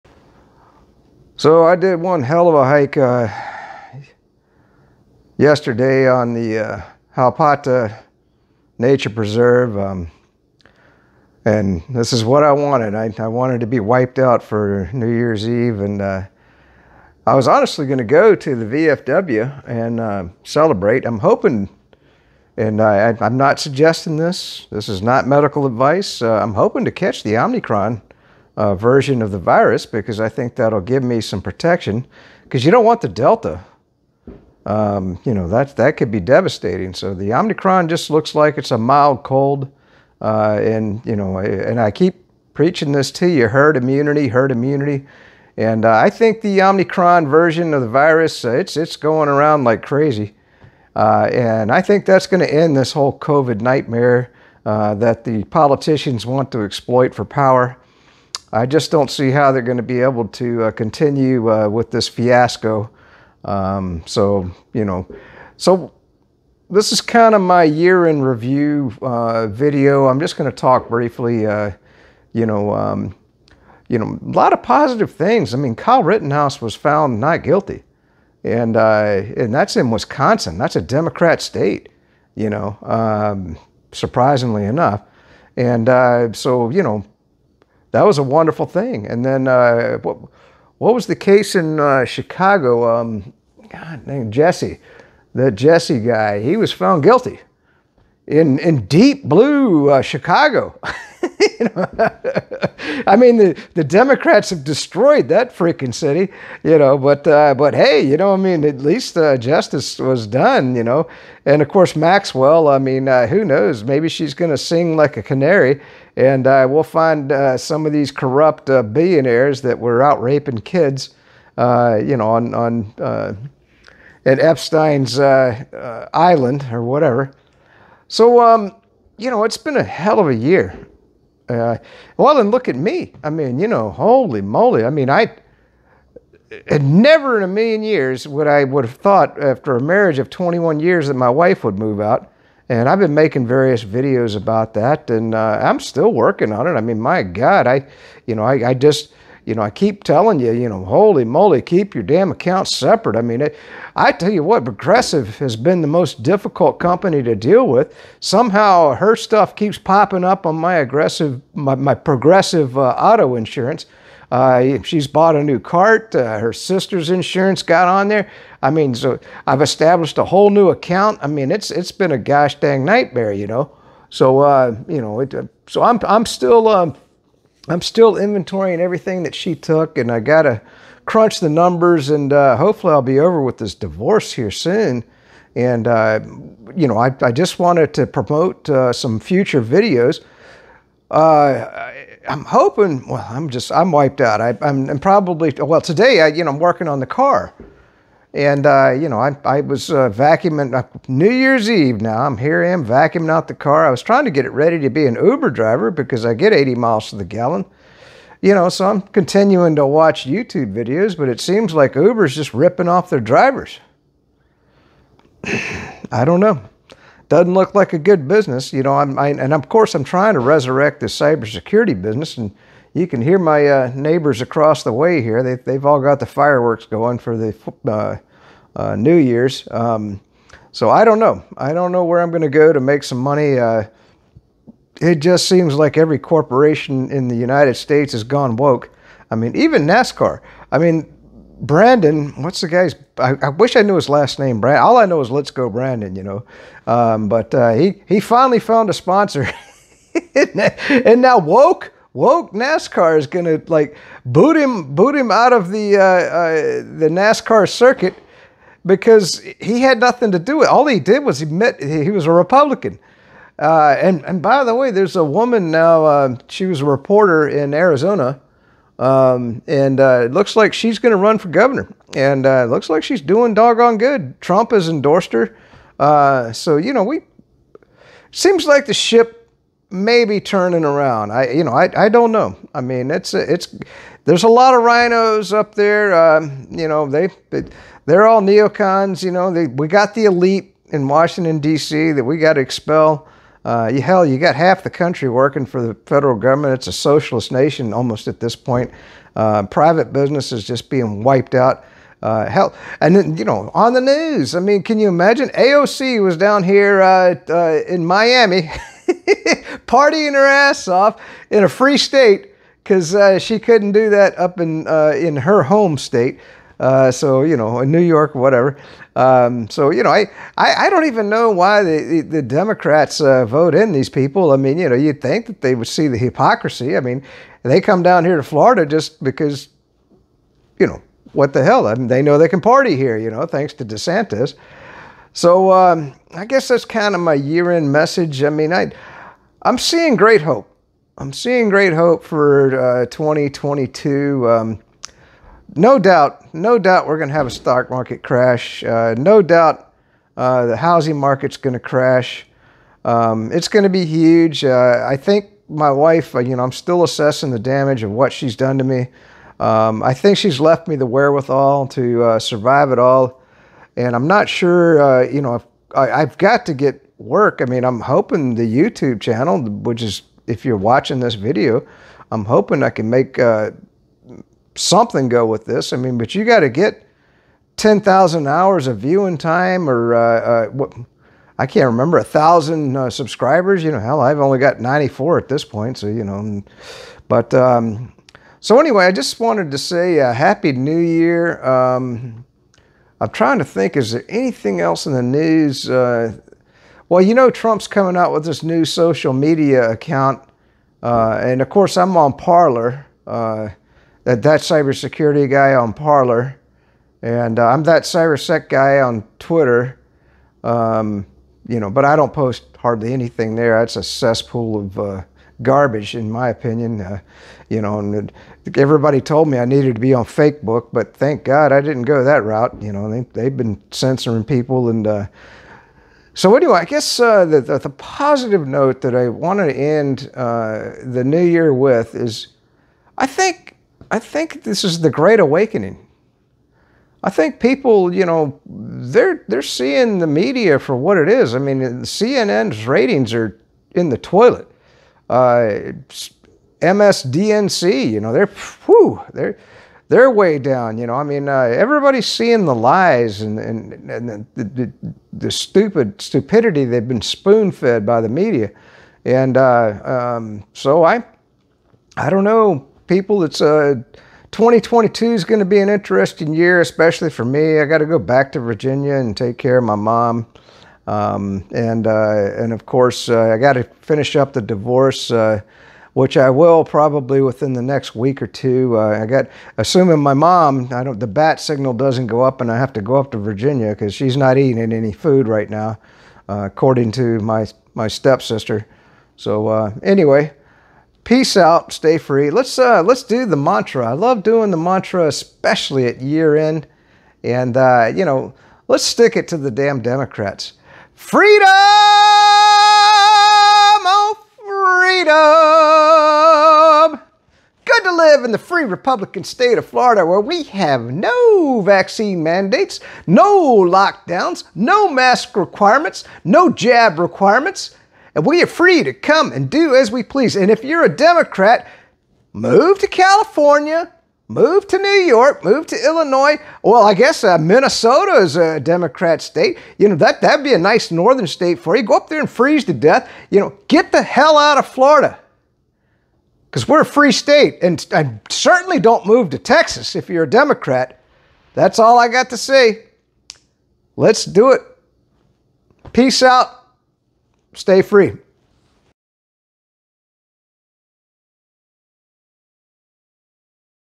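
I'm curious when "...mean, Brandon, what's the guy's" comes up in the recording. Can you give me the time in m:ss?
4:00.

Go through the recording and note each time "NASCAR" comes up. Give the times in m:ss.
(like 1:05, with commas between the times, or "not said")
3:59, 4:12, 4:17.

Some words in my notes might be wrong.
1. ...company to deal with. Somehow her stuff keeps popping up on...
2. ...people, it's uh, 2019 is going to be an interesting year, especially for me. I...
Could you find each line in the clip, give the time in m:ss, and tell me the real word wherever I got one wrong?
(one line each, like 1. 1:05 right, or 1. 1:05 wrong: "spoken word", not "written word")
1. 2:36 right
2. 7:43 wrong: "2022", not "2019".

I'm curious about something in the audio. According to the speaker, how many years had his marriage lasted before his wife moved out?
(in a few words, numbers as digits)
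21.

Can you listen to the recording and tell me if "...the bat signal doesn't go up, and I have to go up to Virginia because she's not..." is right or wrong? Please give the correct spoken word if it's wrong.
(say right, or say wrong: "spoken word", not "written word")
right.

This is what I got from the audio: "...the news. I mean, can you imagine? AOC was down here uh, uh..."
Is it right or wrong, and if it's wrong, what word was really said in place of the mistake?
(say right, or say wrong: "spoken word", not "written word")
right.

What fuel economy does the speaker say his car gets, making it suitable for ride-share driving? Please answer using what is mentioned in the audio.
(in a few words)
80 miles to the gallon.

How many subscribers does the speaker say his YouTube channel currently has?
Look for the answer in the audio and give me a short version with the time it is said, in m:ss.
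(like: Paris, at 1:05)
94, at 6:24.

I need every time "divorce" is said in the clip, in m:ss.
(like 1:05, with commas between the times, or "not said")
3:03, 7:54.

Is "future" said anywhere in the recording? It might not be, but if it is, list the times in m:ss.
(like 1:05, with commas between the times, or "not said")
3:09.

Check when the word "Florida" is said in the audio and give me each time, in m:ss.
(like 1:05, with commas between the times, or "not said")
5:28, 8:29, 8:54.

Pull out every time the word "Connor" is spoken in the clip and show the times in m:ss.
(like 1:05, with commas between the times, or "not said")
not said.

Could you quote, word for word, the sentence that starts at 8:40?
And if you're a Democrat, move to California, Move to New York, move to Illinois.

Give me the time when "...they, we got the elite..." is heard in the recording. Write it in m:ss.
4:49.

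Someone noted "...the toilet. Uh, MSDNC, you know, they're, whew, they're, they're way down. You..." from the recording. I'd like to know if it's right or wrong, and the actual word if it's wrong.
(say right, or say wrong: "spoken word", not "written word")
right.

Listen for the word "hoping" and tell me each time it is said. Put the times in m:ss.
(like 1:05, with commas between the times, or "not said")
0:21, 0:26, 3:12, 6:07, 6:12.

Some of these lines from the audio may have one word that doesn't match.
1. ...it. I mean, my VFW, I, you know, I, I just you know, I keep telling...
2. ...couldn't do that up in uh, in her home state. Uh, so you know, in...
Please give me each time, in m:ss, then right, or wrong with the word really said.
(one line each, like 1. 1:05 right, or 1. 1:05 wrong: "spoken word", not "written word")
1. 2:26 wrong: "God", not "VFW"
2. 5:13 right.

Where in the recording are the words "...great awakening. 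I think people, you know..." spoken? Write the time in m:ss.
7:15.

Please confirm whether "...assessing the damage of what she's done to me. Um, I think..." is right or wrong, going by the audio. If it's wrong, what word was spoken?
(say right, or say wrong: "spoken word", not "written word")
right.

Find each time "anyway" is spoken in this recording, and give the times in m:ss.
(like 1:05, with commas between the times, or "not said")
6:28, 7:06, 8:10.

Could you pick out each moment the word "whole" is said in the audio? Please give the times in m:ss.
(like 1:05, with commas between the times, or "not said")
0:52, 2:50.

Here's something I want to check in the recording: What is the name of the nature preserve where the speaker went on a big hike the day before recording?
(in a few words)
Halpata Nature Preserve.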